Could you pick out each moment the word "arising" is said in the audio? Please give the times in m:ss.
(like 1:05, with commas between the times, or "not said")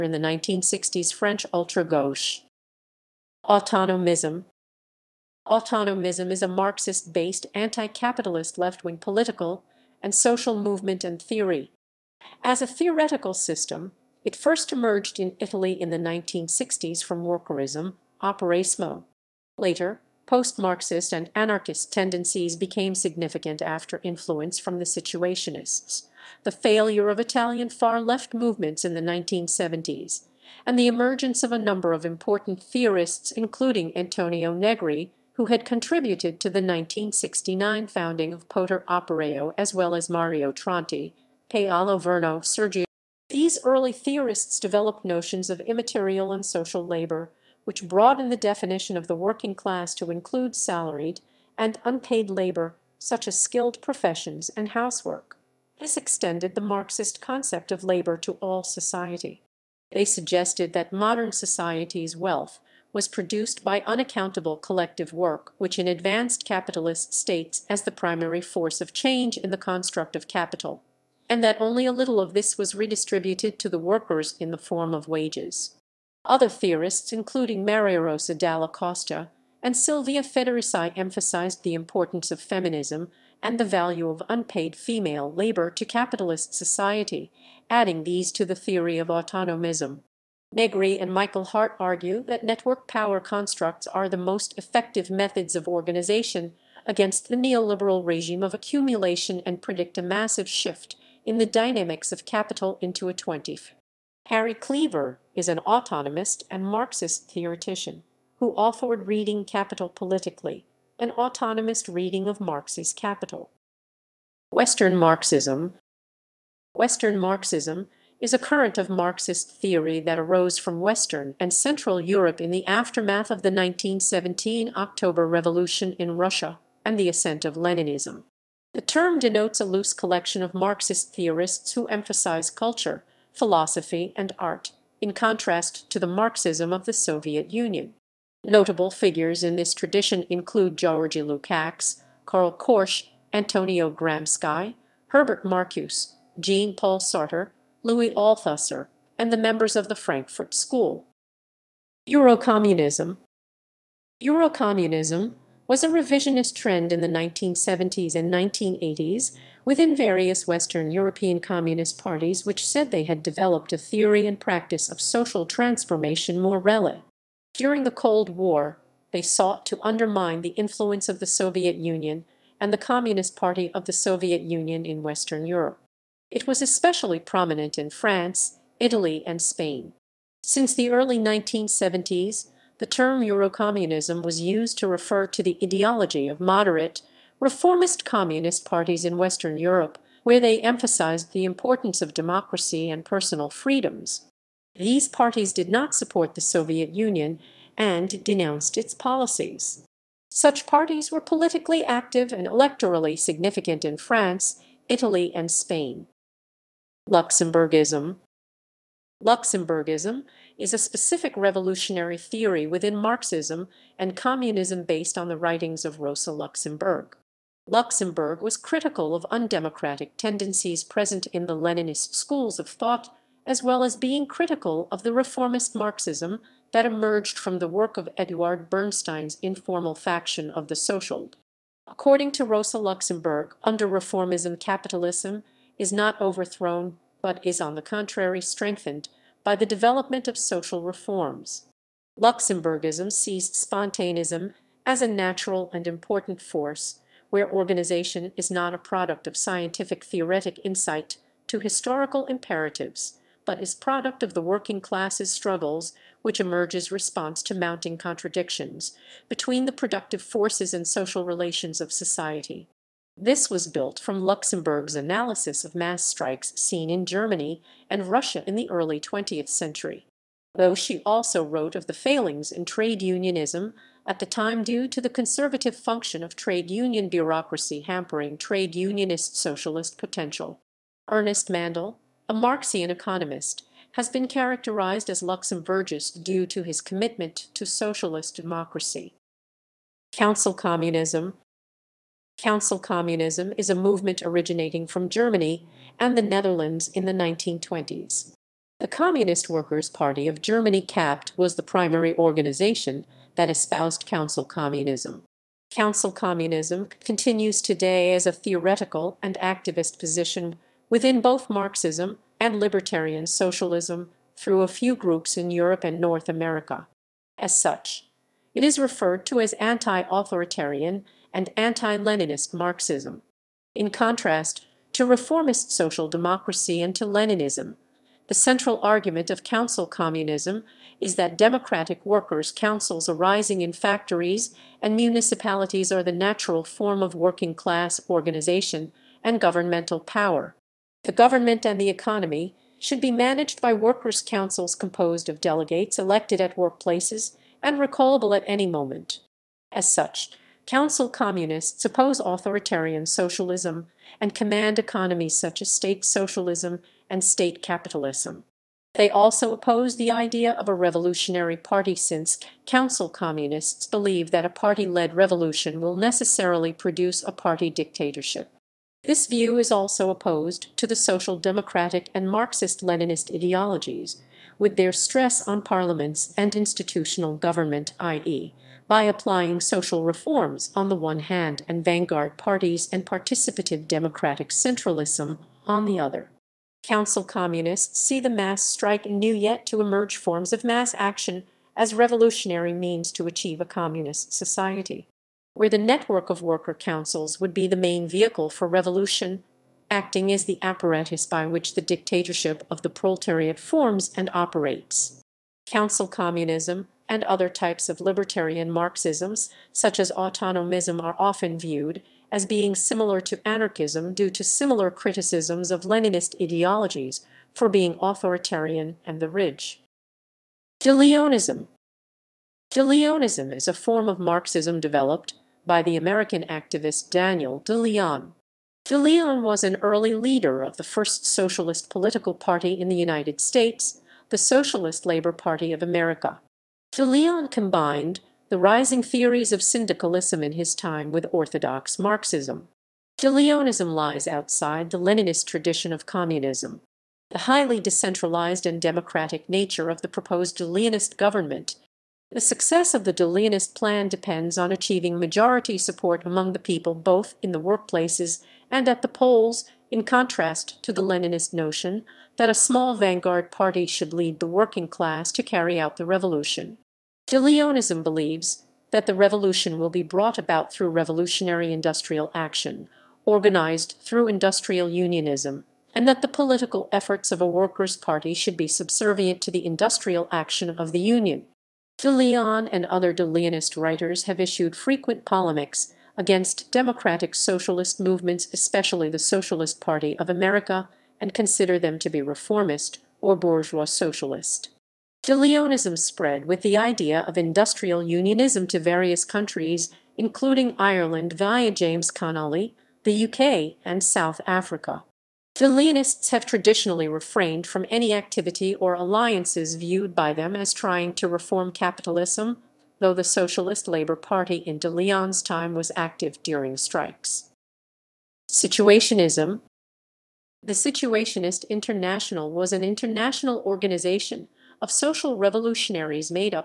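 5:33.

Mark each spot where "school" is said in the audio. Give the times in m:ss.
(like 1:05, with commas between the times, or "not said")
2:30, 3:42.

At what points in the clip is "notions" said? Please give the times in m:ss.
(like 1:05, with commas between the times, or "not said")
0:45, 7:41.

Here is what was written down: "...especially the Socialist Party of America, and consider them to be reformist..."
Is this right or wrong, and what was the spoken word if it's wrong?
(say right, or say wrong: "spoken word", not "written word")
right.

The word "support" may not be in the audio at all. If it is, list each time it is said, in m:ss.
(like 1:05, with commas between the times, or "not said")
3:15, 7:35.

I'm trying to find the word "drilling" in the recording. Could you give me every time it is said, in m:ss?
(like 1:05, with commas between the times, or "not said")
not said.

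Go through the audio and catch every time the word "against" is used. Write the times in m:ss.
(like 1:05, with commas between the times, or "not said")
1:36, 8:06.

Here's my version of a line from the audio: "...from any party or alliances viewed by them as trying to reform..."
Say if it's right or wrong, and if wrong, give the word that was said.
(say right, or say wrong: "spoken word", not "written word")
wrong: "activity", not "party".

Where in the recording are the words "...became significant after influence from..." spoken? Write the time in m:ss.
0:22.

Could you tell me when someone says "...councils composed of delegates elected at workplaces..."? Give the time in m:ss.
5:44.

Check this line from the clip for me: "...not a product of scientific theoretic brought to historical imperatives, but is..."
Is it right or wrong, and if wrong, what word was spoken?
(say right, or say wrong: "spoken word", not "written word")
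wrong: "insight", not "brought".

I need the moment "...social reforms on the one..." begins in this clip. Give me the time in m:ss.
6:19.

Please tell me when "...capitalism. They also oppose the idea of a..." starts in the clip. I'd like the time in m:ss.
5:57.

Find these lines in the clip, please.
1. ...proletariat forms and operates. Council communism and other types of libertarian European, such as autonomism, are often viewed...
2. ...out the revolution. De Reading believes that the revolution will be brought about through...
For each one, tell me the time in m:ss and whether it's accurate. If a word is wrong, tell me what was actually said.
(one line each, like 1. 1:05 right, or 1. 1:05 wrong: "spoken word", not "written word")
1. 6:42 wrong: "Marxisms", not "European"
2. 7:45 wrong: "Leonism", not "Reading".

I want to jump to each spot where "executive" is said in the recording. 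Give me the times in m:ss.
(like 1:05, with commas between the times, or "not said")
not said.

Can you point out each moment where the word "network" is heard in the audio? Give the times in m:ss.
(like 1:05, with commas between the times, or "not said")
1:32, 6:35.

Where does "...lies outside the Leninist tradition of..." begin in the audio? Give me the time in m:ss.
7:23.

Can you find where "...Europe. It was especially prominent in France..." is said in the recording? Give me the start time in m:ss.
2:55.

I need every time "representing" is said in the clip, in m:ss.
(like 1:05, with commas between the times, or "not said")
not said.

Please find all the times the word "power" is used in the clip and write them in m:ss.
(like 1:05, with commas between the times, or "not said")
1:32, 5:39.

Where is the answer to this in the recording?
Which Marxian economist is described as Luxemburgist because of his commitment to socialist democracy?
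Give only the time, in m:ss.
4:41.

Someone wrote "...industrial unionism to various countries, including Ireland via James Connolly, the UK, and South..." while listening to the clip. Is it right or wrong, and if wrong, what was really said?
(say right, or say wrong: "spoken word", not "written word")
right.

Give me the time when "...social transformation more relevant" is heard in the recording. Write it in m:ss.
2:45.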